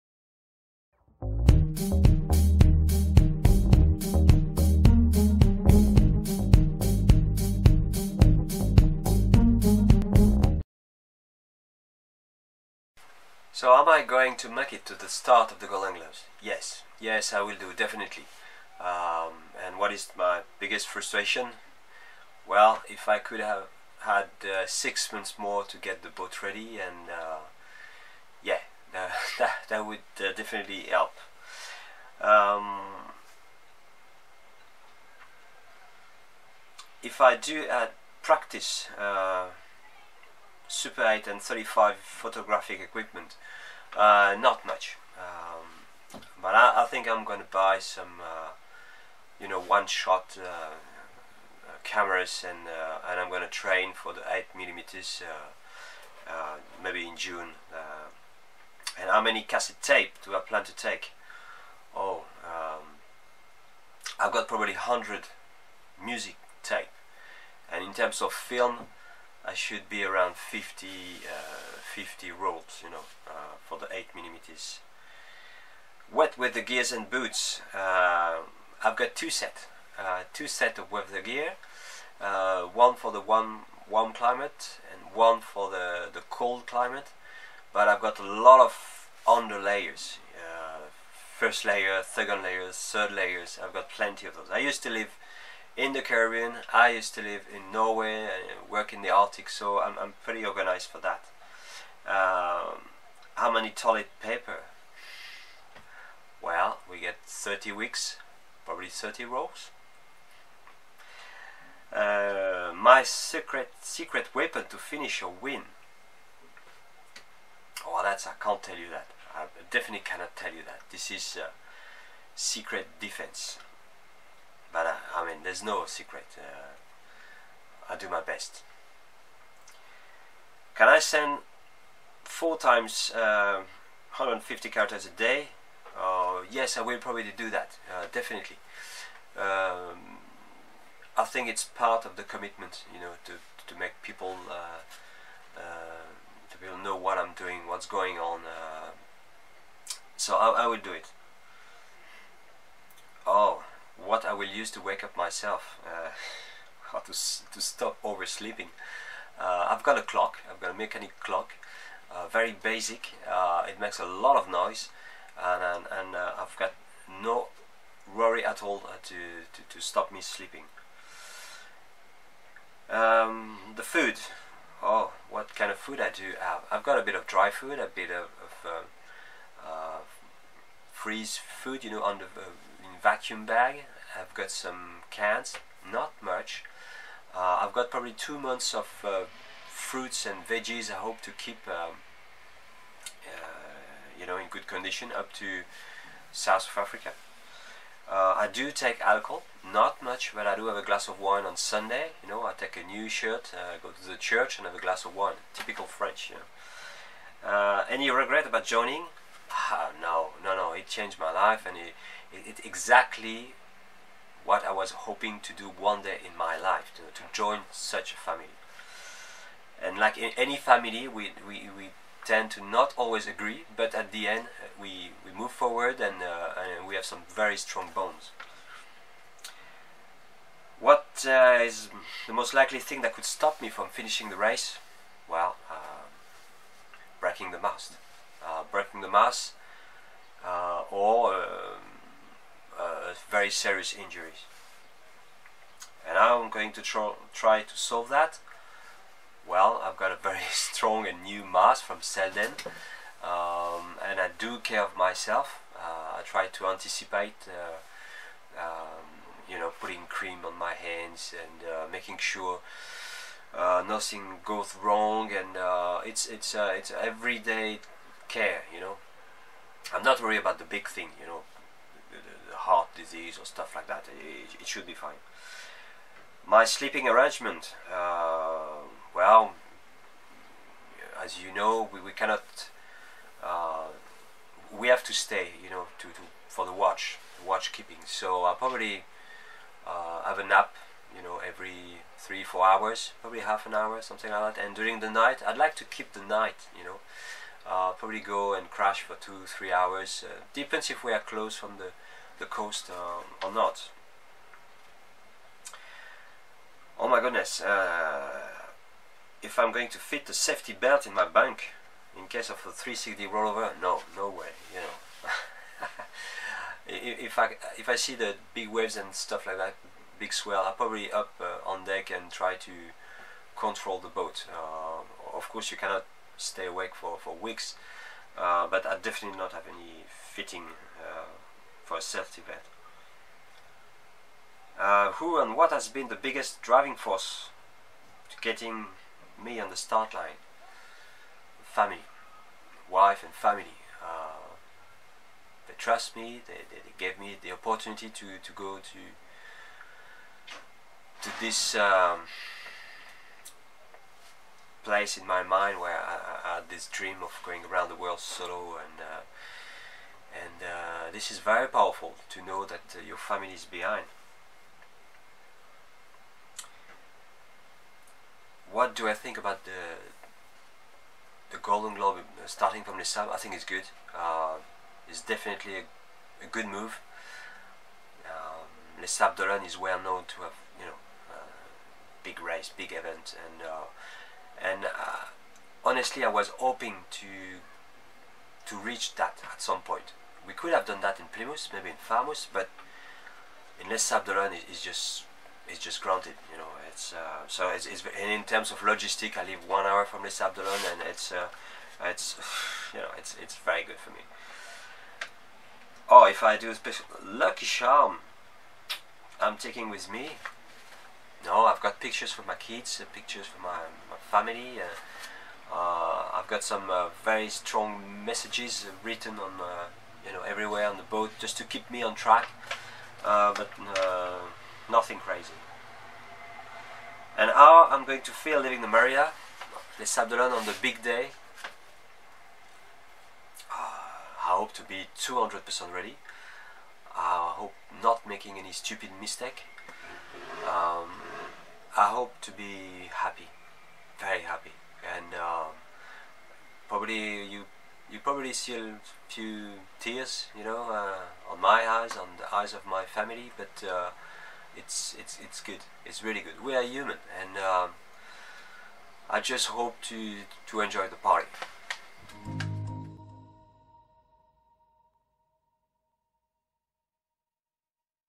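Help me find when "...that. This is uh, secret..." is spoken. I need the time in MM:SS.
02:00.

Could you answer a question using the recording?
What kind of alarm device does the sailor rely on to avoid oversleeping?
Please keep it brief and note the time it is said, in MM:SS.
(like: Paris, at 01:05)
mechanic clock, at 02:40.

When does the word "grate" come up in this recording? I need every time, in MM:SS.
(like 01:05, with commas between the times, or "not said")
not said.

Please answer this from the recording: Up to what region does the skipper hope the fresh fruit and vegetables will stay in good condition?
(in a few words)
South of Africa.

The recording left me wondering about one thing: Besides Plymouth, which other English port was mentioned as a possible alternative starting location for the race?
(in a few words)
Falmouth.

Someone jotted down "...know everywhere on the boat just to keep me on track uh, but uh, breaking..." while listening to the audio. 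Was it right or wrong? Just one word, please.
wrong.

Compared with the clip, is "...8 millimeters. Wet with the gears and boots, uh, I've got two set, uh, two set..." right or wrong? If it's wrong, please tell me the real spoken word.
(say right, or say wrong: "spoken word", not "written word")
right.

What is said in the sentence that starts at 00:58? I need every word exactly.
and how many cassette tape do I plan to take?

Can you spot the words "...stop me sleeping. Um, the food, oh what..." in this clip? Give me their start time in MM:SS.
02:49.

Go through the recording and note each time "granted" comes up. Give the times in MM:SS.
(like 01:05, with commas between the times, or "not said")
06:36.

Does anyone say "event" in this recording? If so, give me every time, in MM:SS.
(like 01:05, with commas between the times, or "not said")
06:22.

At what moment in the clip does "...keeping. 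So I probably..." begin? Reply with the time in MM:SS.
04:47.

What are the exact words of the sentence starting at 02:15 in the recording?
Uh, yes, I will probably do that, uh, definitely.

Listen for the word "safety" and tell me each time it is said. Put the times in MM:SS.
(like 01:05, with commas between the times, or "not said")
05:10, 05:32.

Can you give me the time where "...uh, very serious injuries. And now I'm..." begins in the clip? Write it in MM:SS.
04:03.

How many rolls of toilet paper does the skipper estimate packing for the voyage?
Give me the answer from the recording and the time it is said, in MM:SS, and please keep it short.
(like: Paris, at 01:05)
30, at 01:48.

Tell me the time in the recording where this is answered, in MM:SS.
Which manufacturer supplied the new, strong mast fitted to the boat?
04:12.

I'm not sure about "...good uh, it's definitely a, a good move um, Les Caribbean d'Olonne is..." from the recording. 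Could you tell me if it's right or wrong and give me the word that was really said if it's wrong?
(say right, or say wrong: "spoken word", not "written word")
wrong: "Sables", not "Caribbean".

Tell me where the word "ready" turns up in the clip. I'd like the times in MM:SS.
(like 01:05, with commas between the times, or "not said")
00:26, 07:15.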